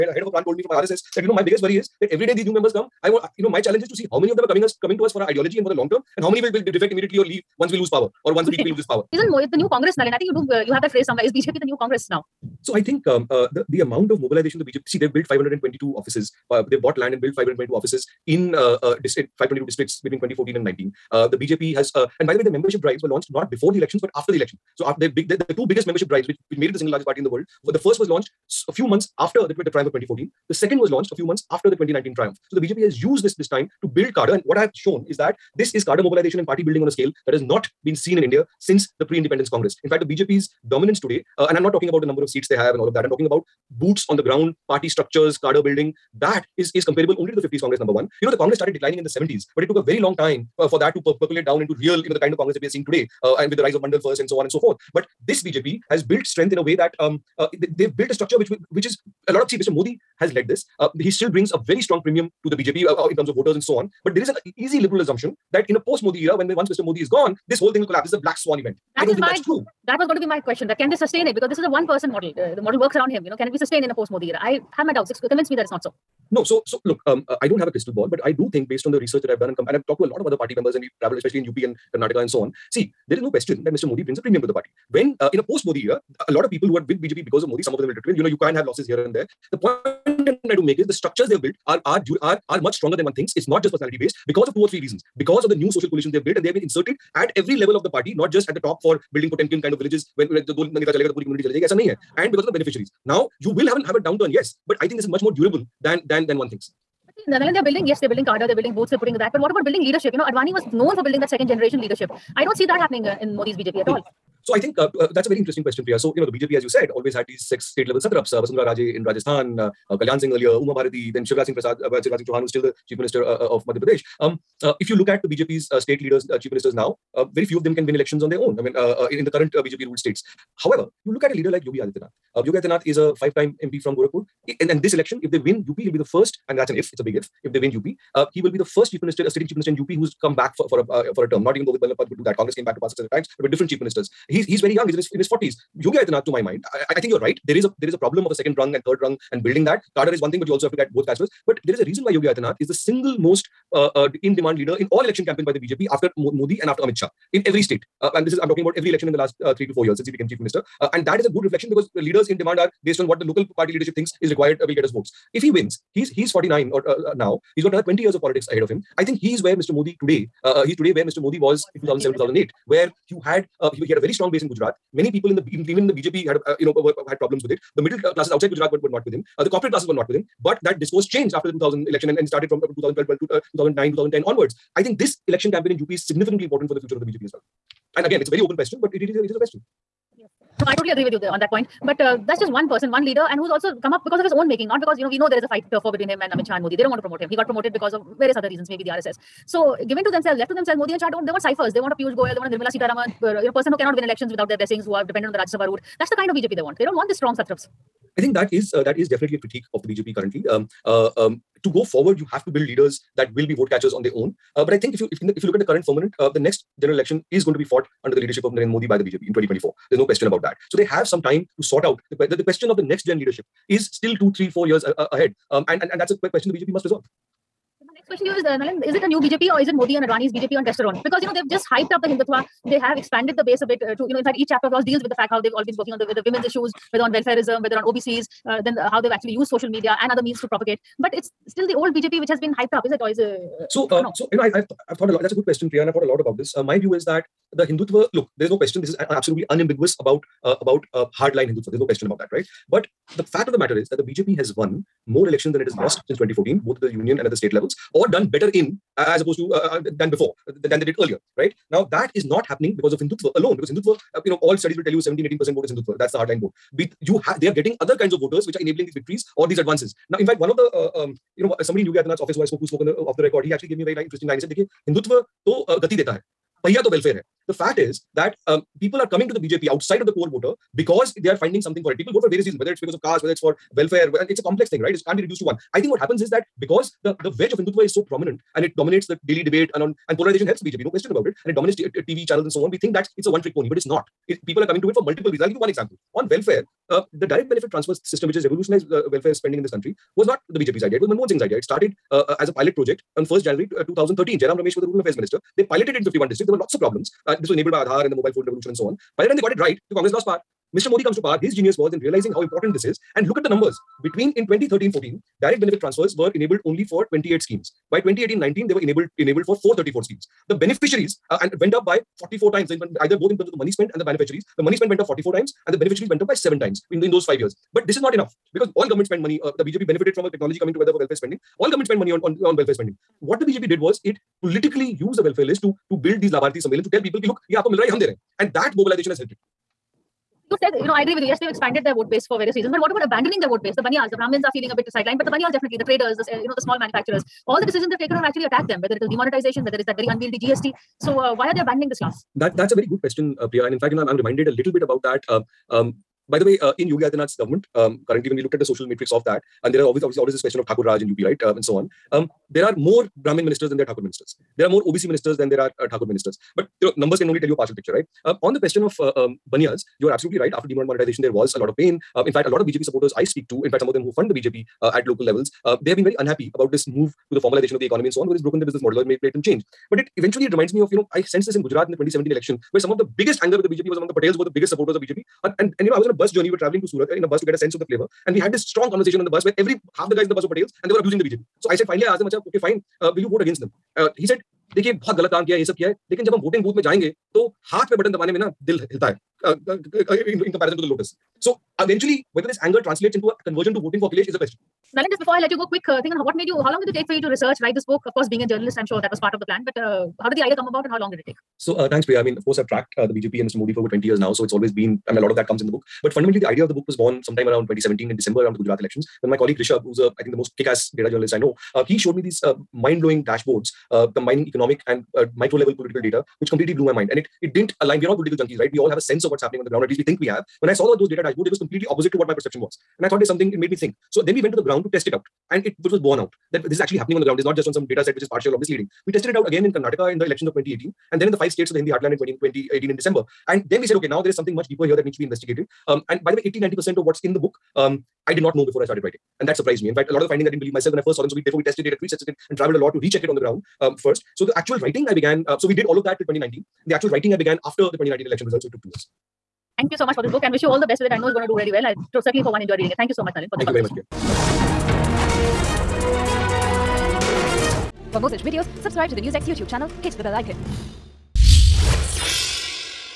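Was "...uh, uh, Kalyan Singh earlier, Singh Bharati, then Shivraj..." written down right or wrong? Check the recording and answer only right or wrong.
wrong.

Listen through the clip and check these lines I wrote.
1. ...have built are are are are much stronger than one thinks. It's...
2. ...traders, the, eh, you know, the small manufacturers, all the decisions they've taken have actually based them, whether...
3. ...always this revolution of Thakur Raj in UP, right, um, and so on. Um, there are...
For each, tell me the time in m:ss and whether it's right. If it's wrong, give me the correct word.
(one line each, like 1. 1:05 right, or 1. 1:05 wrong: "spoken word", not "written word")
1. 1:31 right
2. 5:45 wrong: "attacked", not "based"
3. 6:00 wrong: "question", not "revolution".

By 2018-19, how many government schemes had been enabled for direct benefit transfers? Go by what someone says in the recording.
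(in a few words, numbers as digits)
434.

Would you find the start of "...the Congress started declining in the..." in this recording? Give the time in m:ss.
0:48.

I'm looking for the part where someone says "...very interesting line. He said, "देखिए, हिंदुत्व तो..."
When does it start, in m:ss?
4:33.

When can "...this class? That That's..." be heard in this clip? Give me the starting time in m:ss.
5:51.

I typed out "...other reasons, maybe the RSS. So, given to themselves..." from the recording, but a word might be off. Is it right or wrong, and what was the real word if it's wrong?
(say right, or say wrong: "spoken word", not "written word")
right.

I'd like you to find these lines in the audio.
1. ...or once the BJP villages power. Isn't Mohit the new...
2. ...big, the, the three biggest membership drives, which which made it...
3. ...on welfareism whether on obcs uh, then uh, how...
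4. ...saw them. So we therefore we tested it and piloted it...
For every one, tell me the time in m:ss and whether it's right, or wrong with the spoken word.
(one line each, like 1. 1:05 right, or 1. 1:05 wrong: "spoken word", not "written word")
1. 0:08 wrong: "loses", not "villages"
2. 0:24 wrong: "two", not "three"
3. 3:57 right
4. 7:31 wrong: "retested", not "piloted".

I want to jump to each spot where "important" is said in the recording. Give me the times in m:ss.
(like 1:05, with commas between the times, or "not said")
3:06, 5:12.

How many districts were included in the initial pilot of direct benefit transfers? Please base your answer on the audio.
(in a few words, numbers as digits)
51.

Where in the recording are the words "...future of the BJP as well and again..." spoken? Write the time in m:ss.
3:06.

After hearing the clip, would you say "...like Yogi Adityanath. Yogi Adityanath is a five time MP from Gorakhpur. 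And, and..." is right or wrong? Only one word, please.
right.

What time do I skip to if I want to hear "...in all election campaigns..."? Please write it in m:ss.
2:34.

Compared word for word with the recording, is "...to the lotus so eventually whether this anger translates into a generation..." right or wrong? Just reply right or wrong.
wrong.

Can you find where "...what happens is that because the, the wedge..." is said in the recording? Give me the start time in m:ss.
4:45.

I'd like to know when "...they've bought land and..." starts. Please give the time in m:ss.
0:16.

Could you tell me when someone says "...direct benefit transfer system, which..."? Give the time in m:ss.
4:57.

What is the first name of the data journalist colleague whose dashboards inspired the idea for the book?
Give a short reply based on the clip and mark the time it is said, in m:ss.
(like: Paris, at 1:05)
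Rishabh, at 6:59.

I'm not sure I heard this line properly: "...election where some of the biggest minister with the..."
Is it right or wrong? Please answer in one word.
wrong.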